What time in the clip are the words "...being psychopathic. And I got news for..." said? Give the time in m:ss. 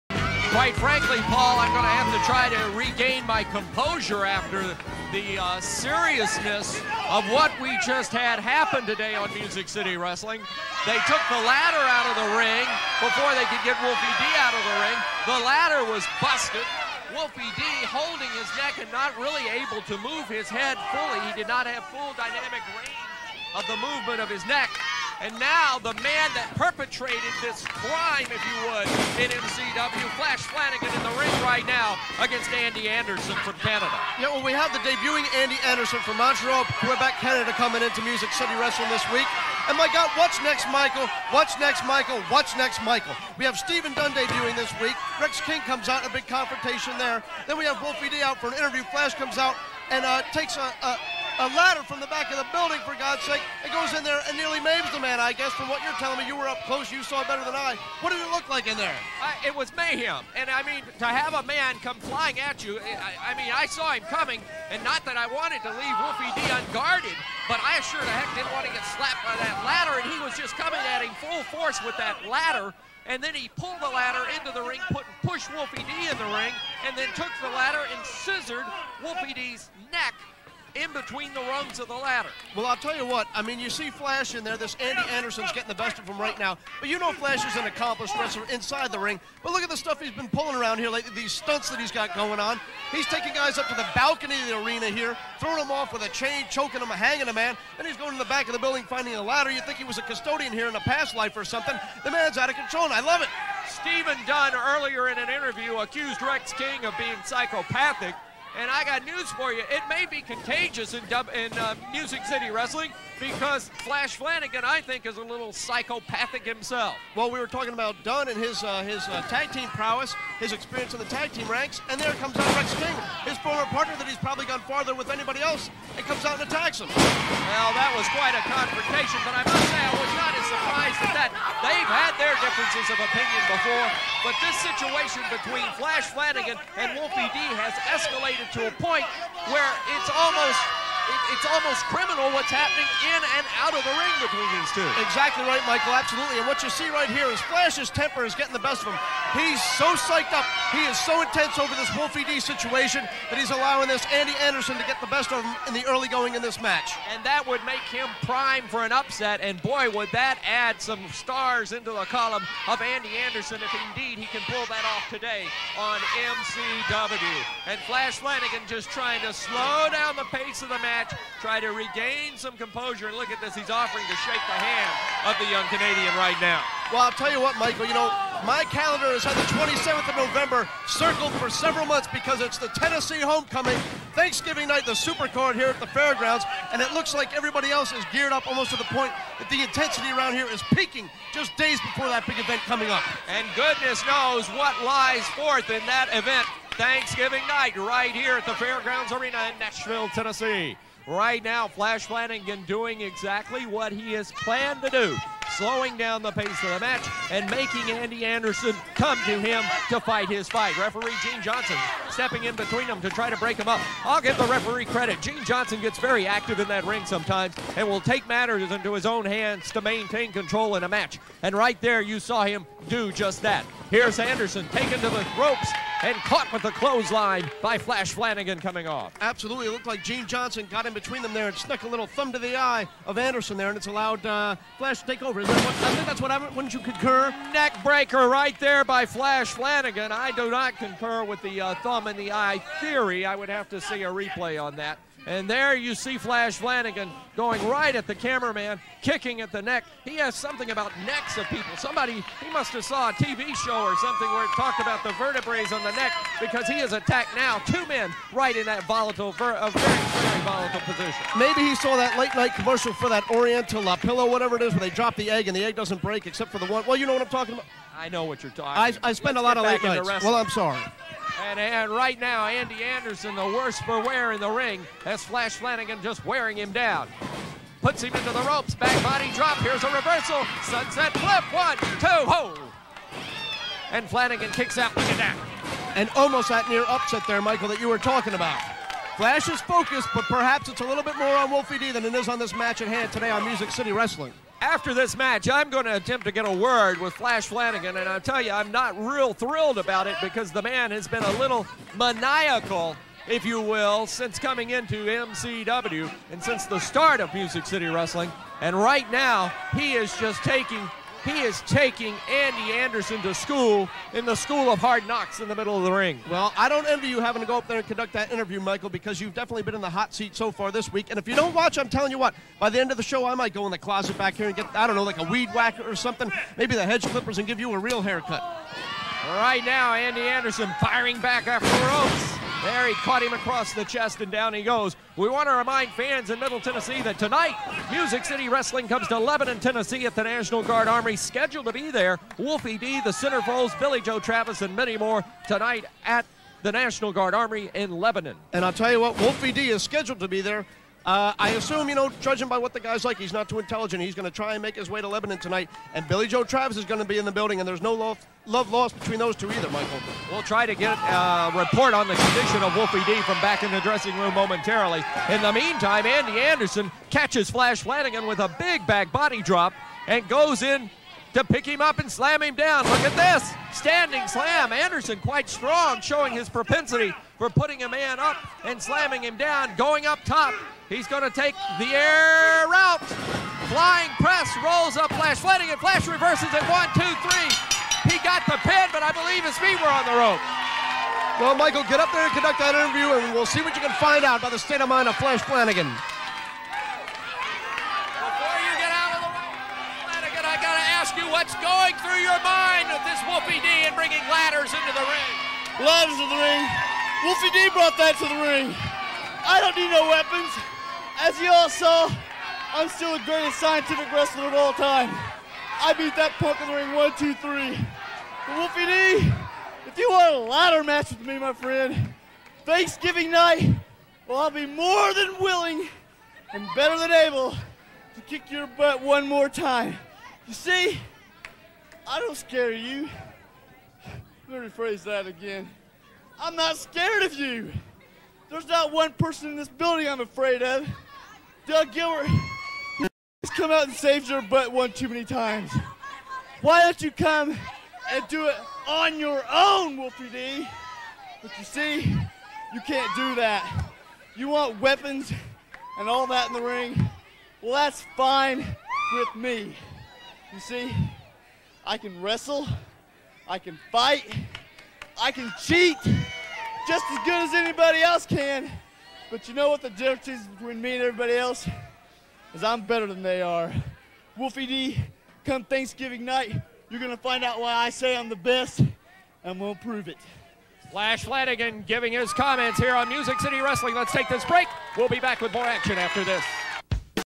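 1:46.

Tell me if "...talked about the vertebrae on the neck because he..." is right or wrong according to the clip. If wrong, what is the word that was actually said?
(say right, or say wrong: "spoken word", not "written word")
right.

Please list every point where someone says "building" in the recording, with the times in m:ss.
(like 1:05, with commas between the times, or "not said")
0:52, 1:38, 5:57, 7:19.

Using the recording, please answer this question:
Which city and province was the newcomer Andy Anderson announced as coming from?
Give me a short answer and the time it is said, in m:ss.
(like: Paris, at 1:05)
Montreal, Quebec, at 0:36.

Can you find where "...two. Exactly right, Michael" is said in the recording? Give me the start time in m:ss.
2:24.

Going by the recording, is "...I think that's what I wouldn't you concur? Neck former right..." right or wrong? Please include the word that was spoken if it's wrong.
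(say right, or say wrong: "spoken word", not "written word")
wrong: "breaker", not "former".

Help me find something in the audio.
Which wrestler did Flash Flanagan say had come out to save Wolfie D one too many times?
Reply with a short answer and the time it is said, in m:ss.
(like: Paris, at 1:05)
Doug Gilbert, at 7:21.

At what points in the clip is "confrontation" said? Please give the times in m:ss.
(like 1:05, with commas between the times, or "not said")
0:46, 2:08.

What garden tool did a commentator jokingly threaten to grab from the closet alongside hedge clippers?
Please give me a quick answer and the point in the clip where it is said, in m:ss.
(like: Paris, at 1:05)
weed whacker, at 5:25.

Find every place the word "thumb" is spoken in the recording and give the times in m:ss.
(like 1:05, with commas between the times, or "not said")
3:52, 4:01.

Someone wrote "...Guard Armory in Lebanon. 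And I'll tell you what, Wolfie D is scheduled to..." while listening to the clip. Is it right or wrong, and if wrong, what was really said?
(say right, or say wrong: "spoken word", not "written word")
right.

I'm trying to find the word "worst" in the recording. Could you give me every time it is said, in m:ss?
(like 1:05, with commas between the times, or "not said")
4:33.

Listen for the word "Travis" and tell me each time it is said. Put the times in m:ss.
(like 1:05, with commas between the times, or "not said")
5:44, 5:56.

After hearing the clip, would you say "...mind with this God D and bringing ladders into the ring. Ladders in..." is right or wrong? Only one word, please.
wrong.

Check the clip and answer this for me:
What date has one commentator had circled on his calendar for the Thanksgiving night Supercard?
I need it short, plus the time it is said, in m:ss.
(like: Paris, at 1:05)
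27th of November, at 2:59.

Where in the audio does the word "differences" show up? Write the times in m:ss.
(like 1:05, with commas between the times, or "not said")
2:12, 7:49.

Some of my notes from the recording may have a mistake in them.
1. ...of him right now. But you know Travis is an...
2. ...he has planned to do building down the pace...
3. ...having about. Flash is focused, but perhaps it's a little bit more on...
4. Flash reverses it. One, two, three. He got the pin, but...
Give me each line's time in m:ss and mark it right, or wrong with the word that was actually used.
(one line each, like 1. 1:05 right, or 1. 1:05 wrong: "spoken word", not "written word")
1. 1:25 wrong: "Flash", not "Travis"
2. 3:23 wrong: "slowing", not "building"
3. 4:47 wrong: "talking", not "having"
4. 6:25 right.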